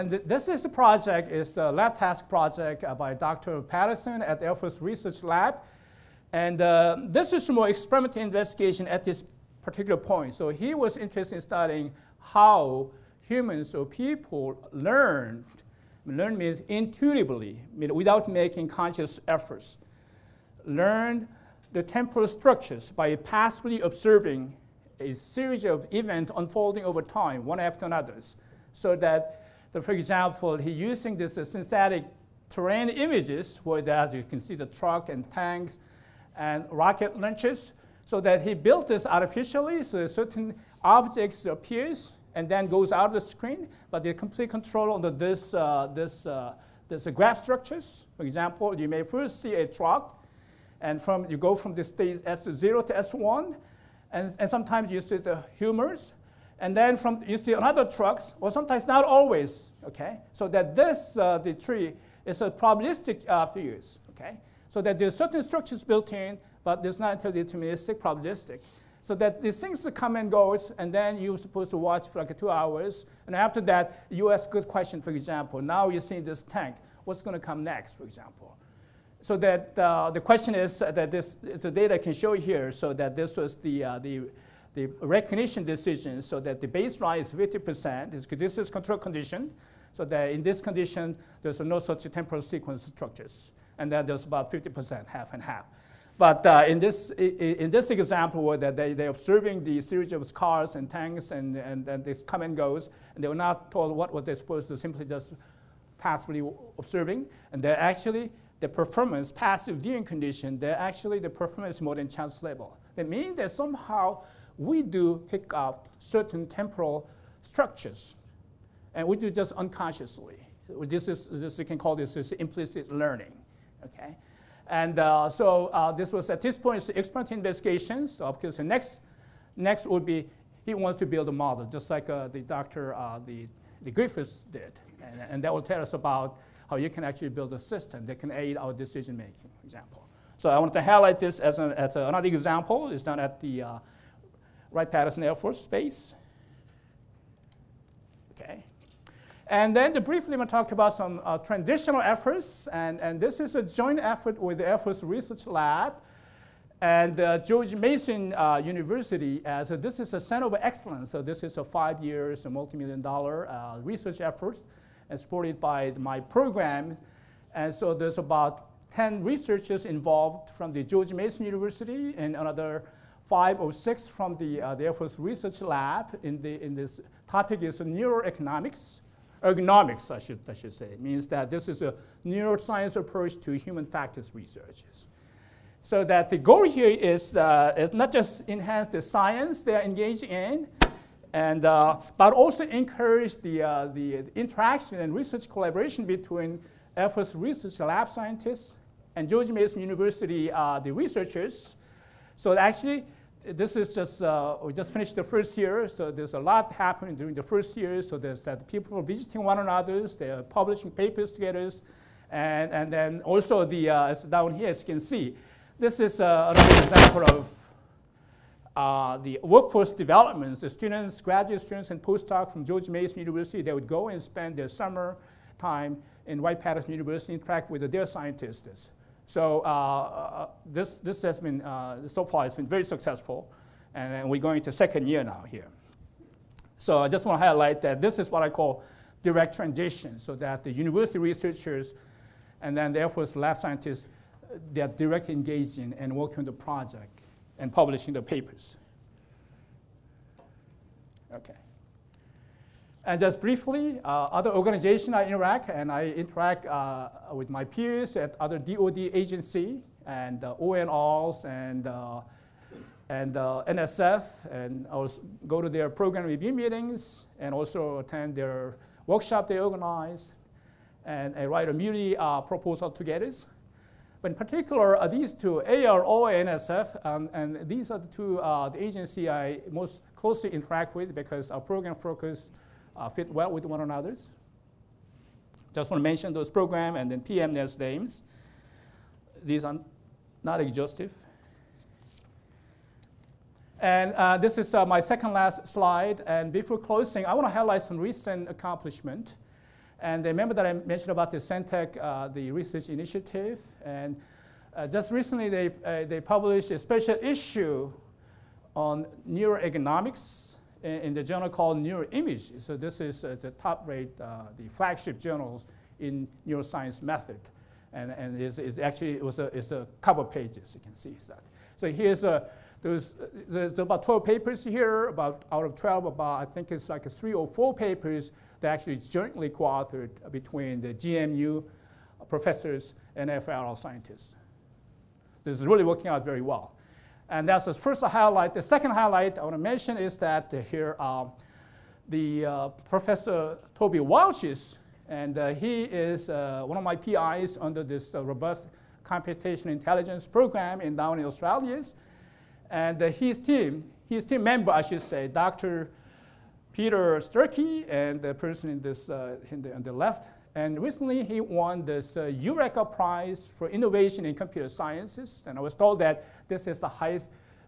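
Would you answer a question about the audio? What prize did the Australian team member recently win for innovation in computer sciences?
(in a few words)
Eureka Prize.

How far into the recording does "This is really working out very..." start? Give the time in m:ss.
5:35.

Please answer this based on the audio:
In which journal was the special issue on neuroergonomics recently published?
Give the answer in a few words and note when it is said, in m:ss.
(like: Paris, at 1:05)
Neuroimage, at 5:11.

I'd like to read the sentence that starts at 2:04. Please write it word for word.
And uh, so uh, this was at this point it's experimental investigation.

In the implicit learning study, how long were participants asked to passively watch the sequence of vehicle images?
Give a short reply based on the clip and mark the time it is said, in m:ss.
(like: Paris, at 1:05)
2 hours, at 1:12.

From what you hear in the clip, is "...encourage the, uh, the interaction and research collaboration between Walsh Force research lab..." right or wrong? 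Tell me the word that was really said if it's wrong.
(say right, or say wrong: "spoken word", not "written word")
wrong: "Air", not "Walsh".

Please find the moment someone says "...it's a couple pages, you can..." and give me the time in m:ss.
5:19.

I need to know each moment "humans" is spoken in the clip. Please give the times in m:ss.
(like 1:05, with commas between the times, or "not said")
0:13, 3:03.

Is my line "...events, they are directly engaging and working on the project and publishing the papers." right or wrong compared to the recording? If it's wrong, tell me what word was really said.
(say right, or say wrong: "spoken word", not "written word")
wrong: "scientists", not "events".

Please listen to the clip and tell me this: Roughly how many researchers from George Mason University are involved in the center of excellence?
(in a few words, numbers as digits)
10.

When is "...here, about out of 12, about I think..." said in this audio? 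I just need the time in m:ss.
5:24.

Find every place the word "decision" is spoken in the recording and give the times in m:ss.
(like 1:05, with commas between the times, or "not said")
1:25, 2:18.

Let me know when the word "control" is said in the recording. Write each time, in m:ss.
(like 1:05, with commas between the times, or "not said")
0:44, 1:28.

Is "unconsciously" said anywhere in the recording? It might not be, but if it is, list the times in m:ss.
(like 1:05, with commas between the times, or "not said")
1:59.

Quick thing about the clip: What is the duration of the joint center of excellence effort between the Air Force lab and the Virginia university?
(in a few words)
5 years.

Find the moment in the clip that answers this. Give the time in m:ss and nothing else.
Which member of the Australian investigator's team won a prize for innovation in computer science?
5:55.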